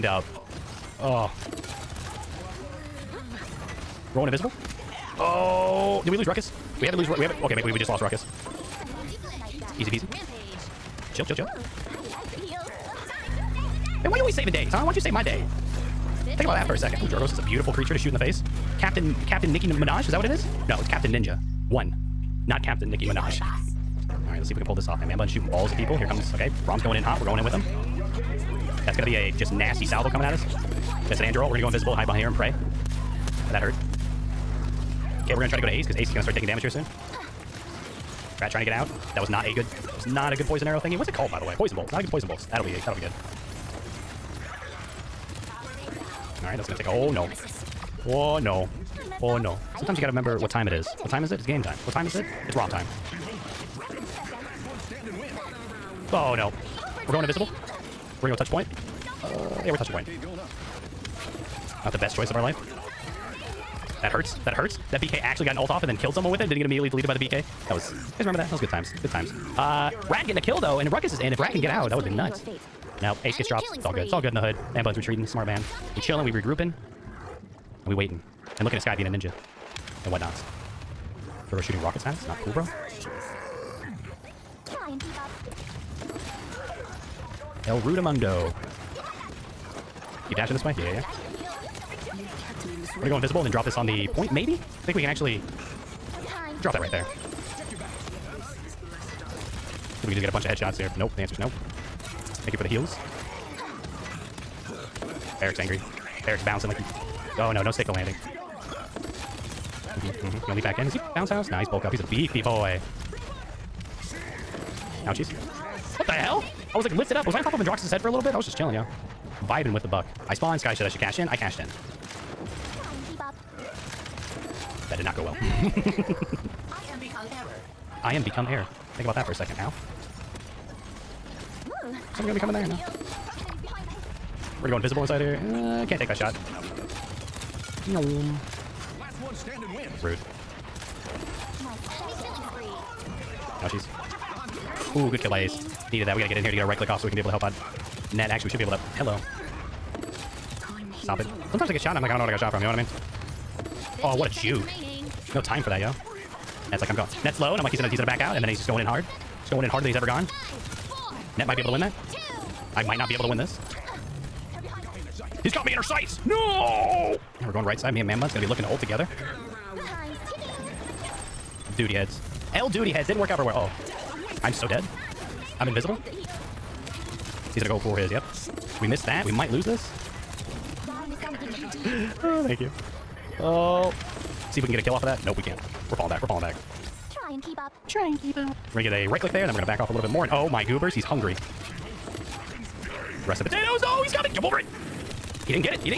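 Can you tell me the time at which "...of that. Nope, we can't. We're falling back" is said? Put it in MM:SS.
03:05.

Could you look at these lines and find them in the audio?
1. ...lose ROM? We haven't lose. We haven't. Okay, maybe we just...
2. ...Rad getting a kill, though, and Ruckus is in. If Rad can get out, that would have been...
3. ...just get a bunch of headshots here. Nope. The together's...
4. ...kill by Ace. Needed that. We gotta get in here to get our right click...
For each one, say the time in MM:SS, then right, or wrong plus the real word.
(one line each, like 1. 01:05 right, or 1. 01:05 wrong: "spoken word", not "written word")
1. 00:06 wrong: "Ruckus", not "ROM"
2. 01:10 right
3. 01:40 wrong: "answer", not "together"
4. 02:25 right.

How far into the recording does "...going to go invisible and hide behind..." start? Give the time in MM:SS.
00:31.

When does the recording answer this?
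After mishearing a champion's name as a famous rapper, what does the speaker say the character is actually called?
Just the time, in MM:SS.
00:20.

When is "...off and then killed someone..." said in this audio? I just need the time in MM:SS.
01:05.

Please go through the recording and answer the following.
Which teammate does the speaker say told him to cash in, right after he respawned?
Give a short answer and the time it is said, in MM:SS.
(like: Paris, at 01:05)
Sky, at 02:00.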